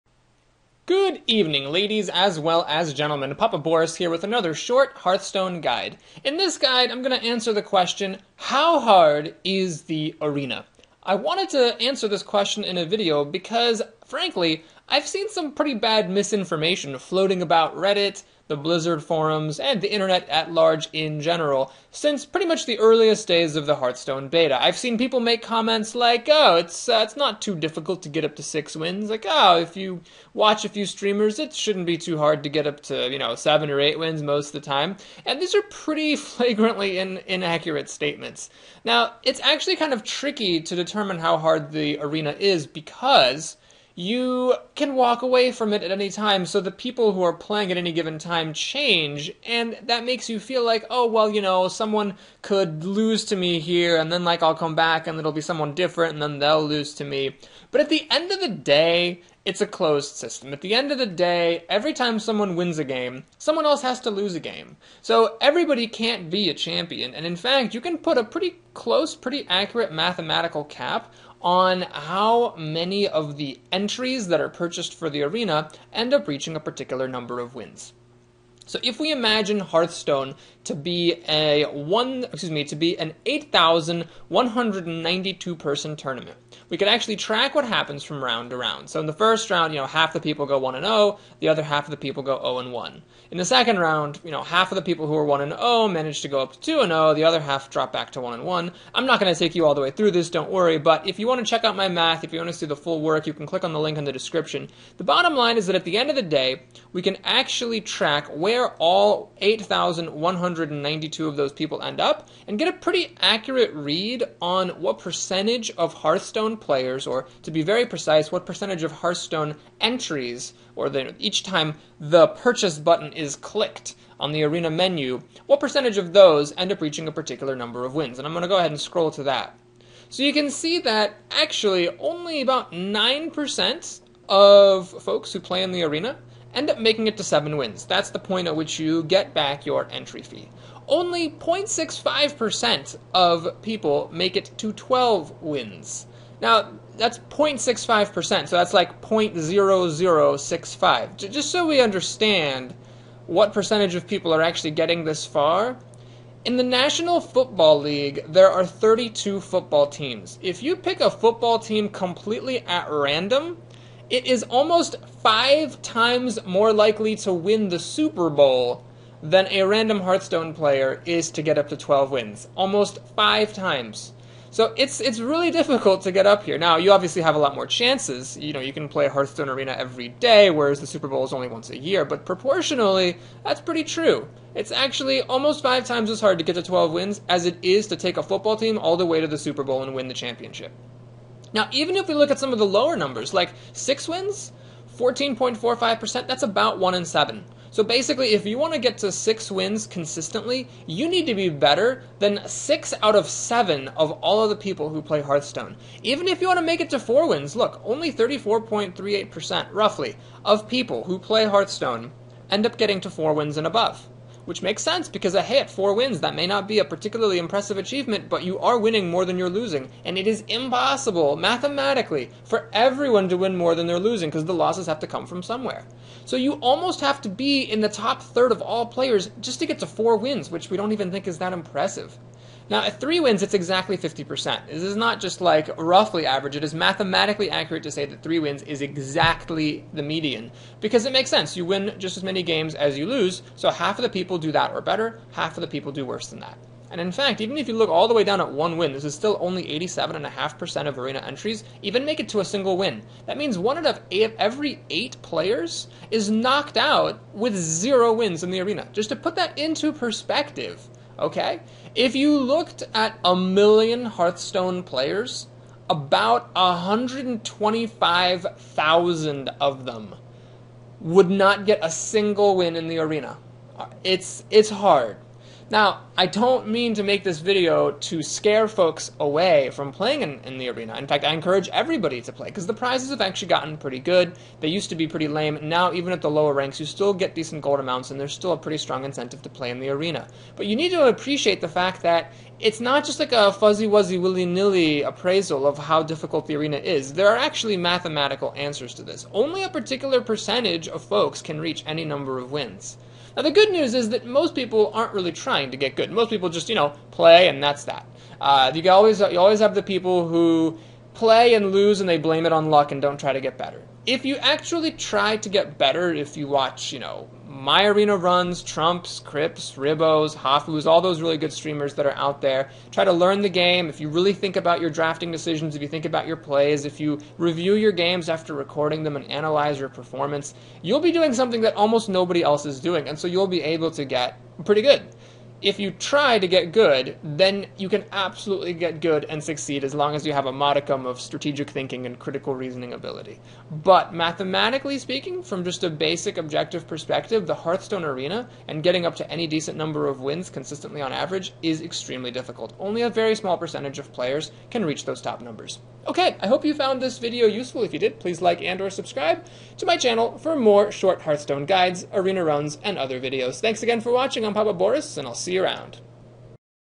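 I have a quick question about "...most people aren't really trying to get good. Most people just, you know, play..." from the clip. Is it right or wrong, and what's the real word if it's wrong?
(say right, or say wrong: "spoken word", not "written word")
right.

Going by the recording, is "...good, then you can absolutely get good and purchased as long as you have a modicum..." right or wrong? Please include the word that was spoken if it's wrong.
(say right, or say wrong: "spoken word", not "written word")
wrong: "succeed", not "purchased".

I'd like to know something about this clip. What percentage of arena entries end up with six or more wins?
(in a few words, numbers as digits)
14.45%.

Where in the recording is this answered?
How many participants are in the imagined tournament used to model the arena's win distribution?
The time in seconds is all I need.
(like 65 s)
83 s.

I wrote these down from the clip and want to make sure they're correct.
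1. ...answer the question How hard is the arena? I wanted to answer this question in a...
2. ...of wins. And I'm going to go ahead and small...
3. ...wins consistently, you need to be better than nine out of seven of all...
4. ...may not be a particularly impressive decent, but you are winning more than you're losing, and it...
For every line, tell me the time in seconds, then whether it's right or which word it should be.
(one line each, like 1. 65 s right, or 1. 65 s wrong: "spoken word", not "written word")
1. 7 s right
2. 127 s wrong: "scroll", not "small"
3. 199 s wrong: "six", not "nine"
4. 216 s wrong: "achievement", not "decent".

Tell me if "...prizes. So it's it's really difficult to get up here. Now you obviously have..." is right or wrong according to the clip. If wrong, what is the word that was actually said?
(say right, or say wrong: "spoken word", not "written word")
wrong: "times", not "prizes".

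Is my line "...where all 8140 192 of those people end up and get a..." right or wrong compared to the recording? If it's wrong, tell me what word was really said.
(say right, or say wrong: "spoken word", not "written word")
wrong: "8100", not "8140".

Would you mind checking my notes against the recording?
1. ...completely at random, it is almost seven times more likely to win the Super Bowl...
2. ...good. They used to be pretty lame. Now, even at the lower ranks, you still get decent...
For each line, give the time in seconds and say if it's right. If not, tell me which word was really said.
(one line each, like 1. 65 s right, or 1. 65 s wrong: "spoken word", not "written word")
1. 161 s wrong: "five", not "seven"
2. 283 s right.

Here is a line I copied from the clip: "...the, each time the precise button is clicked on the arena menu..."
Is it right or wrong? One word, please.
wrong.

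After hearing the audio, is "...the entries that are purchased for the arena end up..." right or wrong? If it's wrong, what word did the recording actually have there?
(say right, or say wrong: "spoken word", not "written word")
right.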